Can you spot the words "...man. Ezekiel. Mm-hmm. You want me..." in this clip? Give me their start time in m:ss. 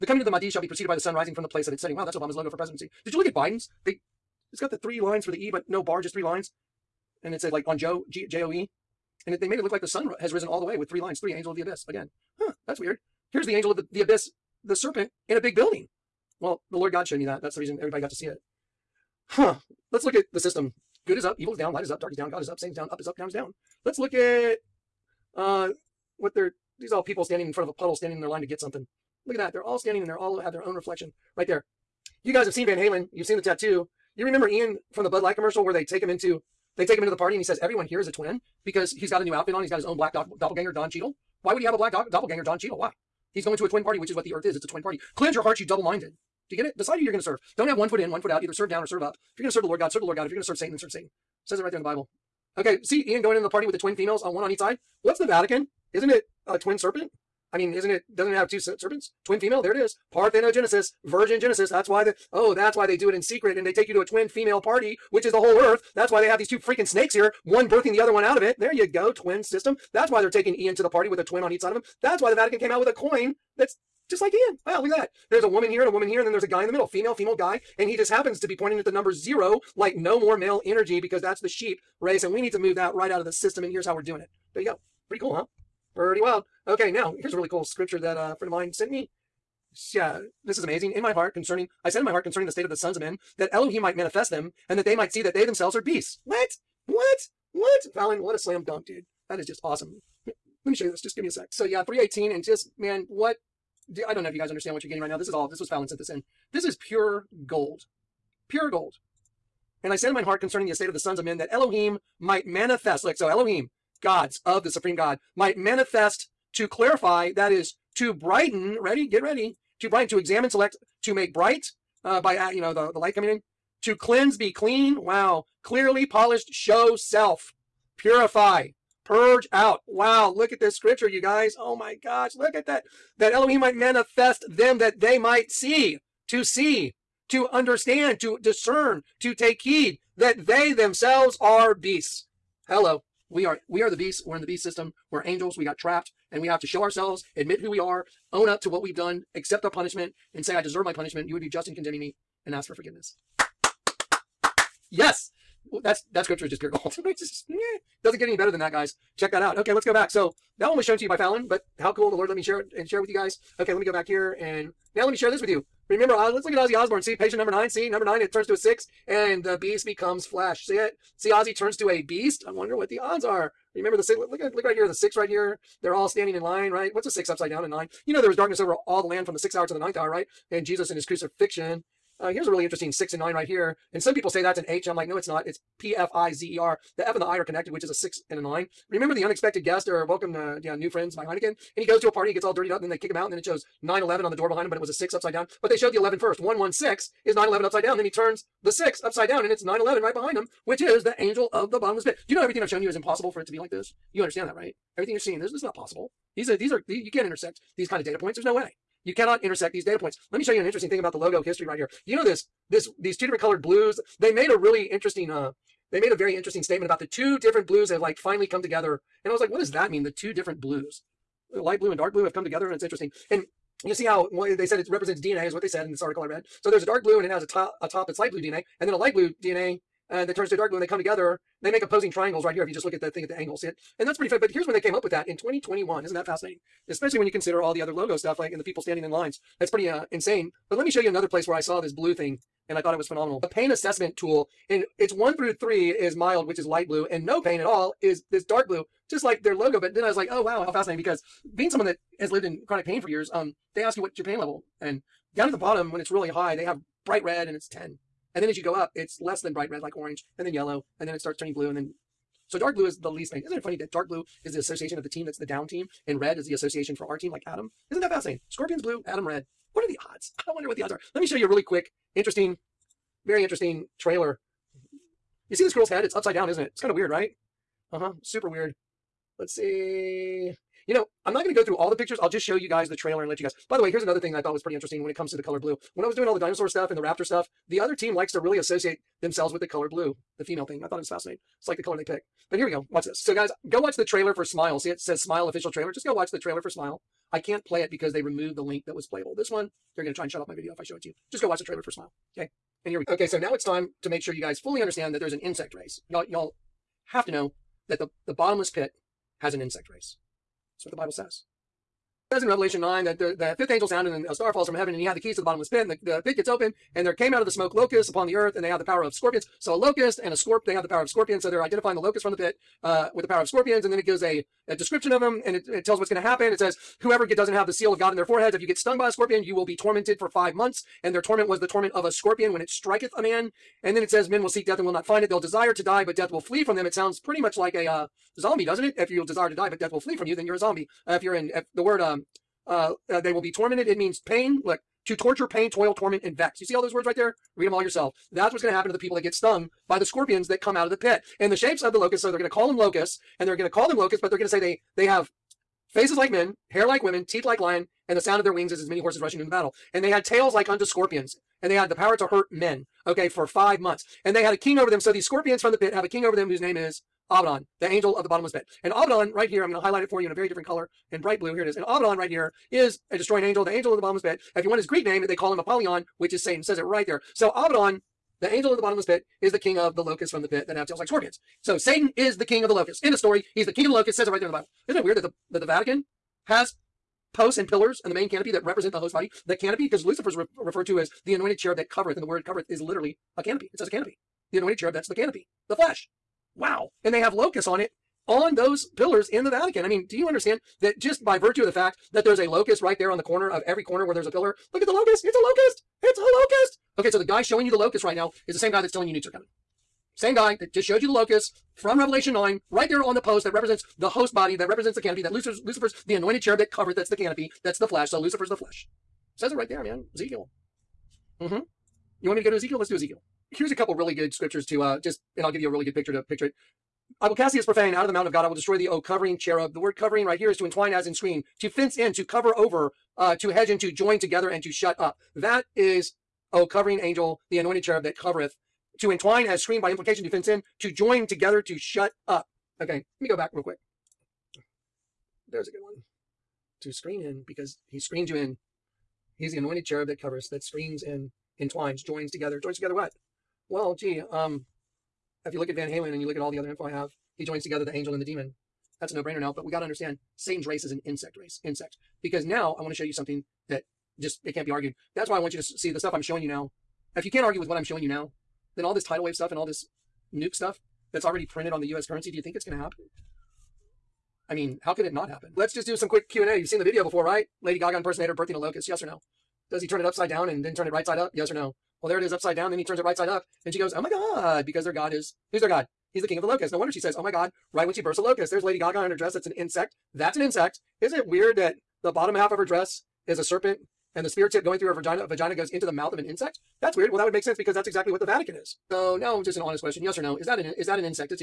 6:59.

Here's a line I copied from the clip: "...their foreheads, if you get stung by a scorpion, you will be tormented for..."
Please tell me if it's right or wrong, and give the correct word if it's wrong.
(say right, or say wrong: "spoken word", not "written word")
right.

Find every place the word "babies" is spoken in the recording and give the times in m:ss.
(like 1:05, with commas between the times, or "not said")
not said.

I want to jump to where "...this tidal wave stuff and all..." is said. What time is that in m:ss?
7:48.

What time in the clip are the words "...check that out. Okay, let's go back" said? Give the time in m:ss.
2:39.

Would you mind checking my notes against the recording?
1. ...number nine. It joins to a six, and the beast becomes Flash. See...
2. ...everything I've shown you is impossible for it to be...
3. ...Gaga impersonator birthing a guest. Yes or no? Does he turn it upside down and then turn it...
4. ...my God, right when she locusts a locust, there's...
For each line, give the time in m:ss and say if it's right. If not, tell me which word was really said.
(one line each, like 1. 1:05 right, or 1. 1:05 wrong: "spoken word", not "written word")
1. 2:47 wrong: "turns", not "joins"
2. 3:22 right
3. 7:57 wrong: "locust", not "guest"
4. 8:07 wrong: "bursts", not "locusts".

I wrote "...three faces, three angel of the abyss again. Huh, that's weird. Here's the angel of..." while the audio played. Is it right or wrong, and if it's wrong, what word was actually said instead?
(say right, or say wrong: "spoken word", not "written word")
wrong: "lines", not "faces".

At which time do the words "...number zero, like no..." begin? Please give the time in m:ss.
1:18.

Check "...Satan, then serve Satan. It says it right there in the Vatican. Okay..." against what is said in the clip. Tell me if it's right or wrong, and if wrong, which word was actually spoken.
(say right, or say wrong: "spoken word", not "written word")
wrong: "Bible", not "Vatican".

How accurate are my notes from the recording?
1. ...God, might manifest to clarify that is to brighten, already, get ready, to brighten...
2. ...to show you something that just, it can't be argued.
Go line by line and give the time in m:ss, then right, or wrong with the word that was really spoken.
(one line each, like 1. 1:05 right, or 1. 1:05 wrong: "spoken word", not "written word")
1. 1:54 wrong: "ready", not "already"
2. 7:42 right.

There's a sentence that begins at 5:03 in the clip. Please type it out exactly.
Okay, so now it's time to make sure you guys fully understand that there's an insect race.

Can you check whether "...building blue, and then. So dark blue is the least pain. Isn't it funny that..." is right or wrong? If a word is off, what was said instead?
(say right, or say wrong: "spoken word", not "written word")
wrong: "turning", not "building".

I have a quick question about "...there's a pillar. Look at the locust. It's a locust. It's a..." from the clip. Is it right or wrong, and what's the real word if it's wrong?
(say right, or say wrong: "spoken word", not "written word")
right.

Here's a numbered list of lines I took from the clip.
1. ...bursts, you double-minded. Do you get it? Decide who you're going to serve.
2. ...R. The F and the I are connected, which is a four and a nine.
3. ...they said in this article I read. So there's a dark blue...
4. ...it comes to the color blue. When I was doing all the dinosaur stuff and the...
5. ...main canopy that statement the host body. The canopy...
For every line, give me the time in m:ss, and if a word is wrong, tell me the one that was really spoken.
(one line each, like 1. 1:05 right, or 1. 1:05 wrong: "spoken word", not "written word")
1. 0:45 wrong: "hearts", not "bursts"
2. 3:06 wrong: "six", not "four"
3. 3:45 right
4. 4:45 right
5. 6:28 wrong: "represent", not "statement".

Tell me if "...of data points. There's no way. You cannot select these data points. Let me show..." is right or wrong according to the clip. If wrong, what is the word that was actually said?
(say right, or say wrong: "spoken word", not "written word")
wrong: "intersect", not "select".